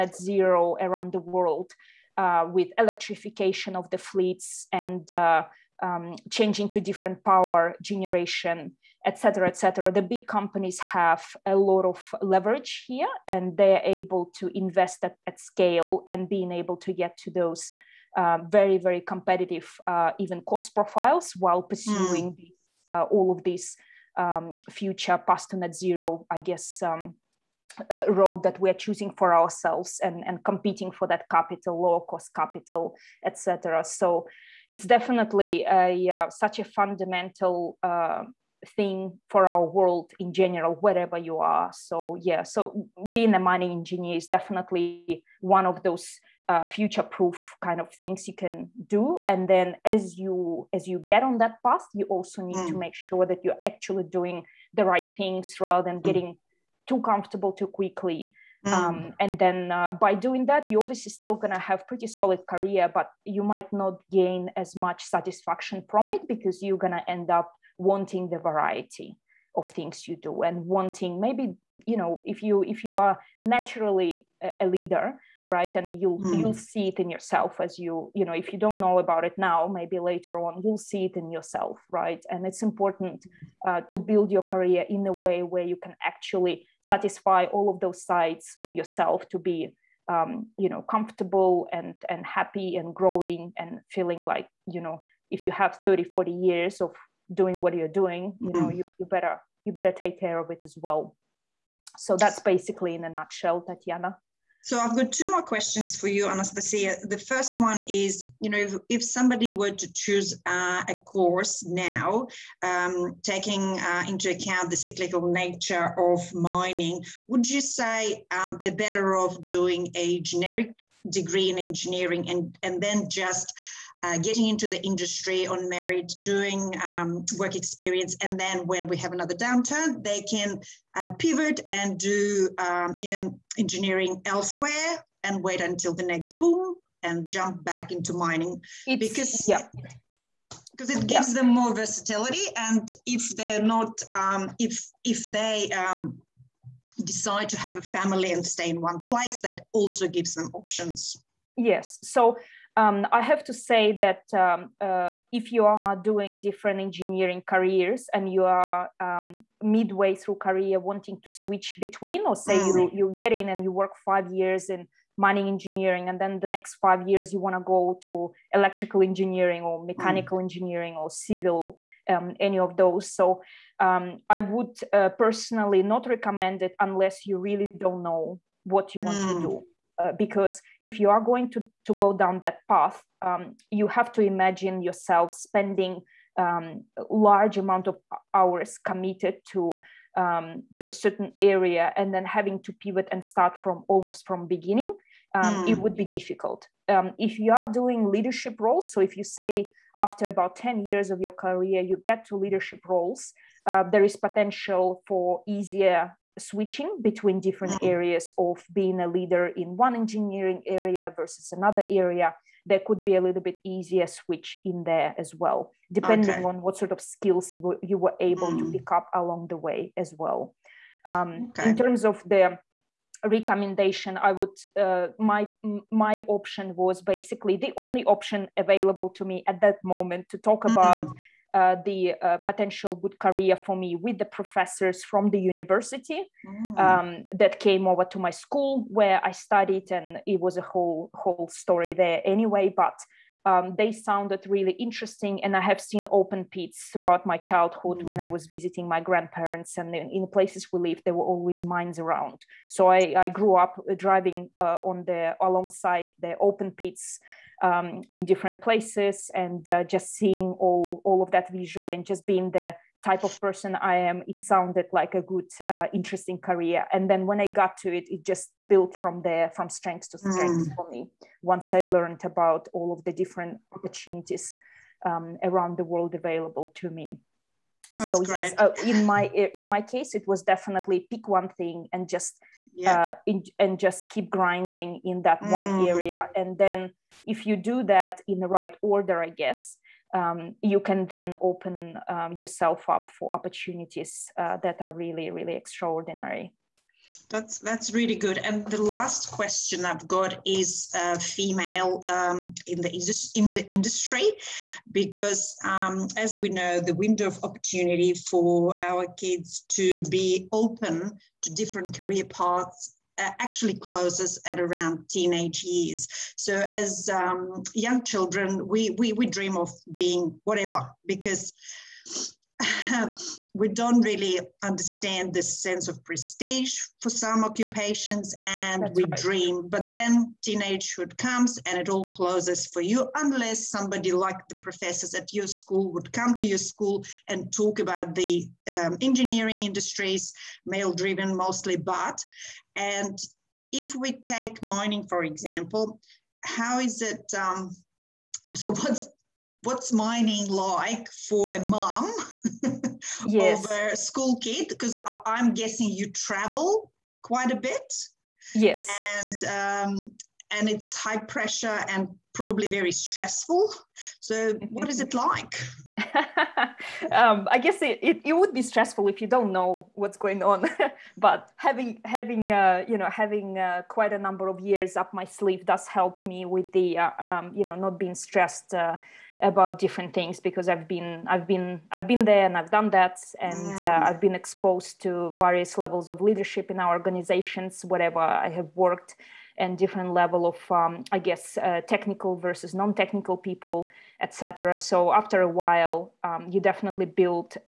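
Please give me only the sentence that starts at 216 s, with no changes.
on what sort of skills you were, you were able mm.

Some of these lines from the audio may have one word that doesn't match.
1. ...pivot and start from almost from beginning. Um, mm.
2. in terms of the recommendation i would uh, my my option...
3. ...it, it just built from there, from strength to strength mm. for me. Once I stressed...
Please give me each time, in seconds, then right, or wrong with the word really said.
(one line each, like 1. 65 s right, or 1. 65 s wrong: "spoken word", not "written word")
1. 192 s right
2. 221 s right
3. 267 s wrong: "learned", not "stressed".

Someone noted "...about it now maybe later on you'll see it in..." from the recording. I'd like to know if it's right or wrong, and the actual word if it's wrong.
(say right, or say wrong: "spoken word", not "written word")
right.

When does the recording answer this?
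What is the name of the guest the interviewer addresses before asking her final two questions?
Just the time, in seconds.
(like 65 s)
106 s.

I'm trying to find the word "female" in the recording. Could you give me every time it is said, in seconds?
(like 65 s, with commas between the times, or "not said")
301 s.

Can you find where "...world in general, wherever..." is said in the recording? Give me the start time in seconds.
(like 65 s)
39 s.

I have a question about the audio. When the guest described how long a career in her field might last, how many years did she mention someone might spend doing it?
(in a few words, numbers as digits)
30 40.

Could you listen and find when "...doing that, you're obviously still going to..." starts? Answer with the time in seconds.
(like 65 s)
60 s.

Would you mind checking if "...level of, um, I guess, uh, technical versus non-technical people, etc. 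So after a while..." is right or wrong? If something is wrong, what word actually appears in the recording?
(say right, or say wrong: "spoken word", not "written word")
right.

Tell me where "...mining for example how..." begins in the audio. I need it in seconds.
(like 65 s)
344 s.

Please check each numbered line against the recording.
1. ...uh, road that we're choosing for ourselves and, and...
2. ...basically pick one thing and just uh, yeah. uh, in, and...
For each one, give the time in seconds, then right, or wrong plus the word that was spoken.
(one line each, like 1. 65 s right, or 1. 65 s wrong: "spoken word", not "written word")
1. 27 s right
2. 280 s wrong: "definitely", not "basically".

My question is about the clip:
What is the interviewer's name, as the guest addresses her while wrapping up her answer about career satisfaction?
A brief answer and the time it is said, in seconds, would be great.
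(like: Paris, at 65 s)
Tatiana, at 103 s.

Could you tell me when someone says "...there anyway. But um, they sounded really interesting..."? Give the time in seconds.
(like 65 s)
241 s.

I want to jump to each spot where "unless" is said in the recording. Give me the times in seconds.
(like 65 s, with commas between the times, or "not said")
176 s, 333 s.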